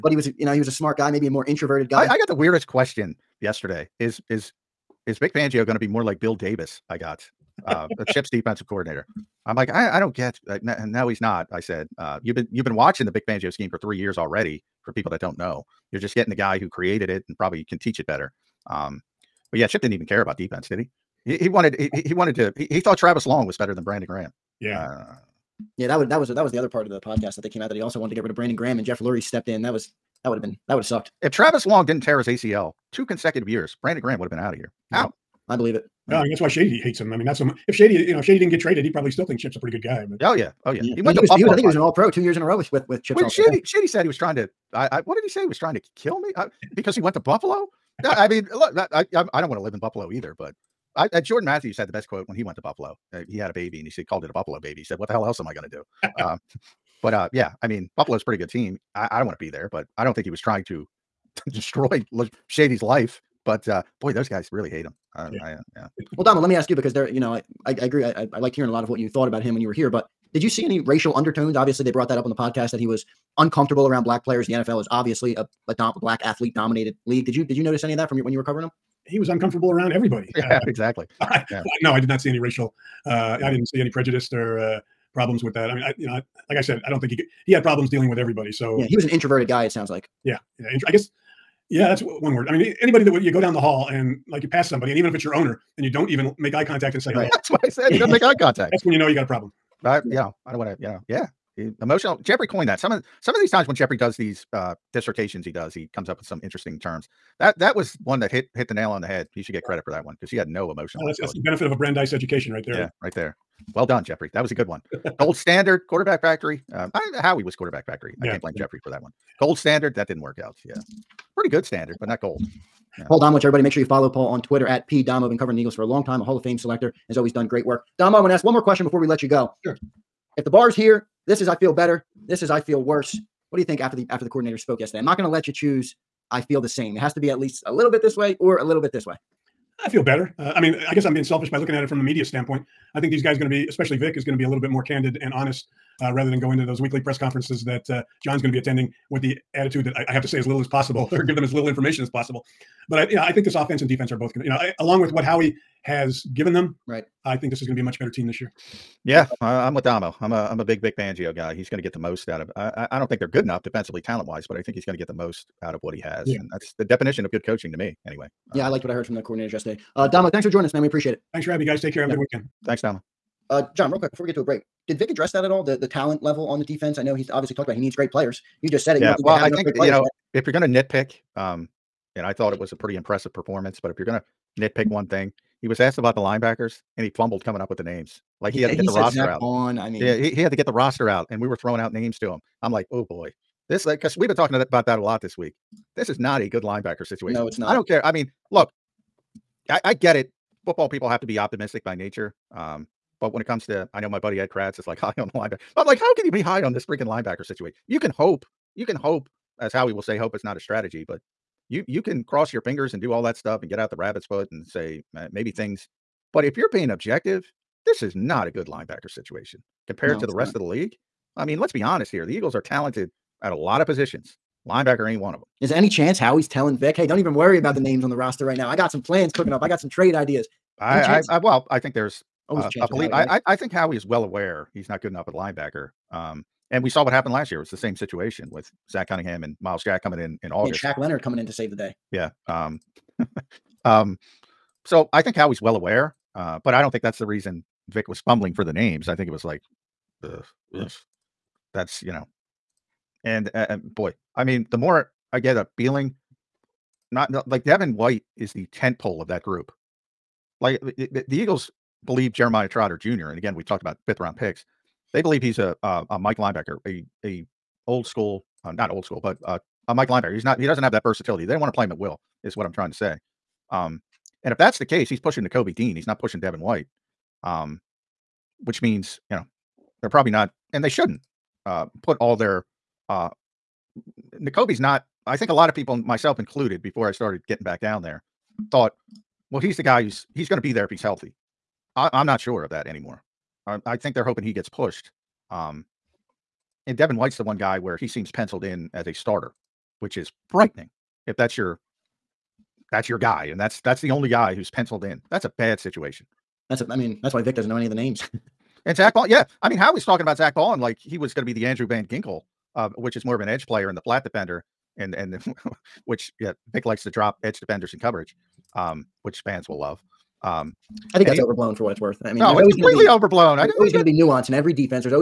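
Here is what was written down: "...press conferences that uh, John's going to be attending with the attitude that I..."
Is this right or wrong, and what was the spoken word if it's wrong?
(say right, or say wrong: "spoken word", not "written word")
right.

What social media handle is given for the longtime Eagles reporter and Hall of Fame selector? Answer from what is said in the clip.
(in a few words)
P Domo.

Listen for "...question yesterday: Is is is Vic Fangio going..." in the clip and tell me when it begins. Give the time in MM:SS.
00:02.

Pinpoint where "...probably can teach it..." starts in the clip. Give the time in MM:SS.
00:17.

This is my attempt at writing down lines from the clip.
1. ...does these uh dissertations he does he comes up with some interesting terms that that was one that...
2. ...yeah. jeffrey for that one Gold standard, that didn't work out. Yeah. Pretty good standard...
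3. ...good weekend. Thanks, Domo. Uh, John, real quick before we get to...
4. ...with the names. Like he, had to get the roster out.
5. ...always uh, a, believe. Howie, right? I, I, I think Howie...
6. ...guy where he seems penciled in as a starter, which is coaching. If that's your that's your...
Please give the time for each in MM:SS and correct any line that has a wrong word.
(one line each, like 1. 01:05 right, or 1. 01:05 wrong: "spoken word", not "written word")
1. 01:43 right
2. 01:58 right
3. 02:52 right
4. 03:07 right
5. 03:52 right
6. 04:57 wrong: "frightening", not "coaching".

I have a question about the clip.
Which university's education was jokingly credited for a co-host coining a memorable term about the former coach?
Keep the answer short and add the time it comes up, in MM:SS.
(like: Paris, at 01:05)
Brandeis, at 01:51.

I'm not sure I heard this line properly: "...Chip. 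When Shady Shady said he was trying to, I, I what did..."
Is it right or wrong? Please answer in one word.
right.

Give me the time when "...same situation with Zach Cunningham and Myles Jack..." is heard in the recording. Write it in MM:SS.
03:57.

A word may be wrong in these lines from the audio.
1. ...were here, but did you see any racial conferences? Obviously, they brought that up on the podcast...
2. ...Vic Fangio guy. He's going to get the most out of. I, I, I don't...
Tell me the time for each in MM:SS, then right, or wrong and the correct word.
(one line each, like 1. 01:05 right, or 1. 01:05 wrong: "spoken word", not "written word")
1. 01:09 wrong: "undertones", not "conferences"
2. 02:40 right.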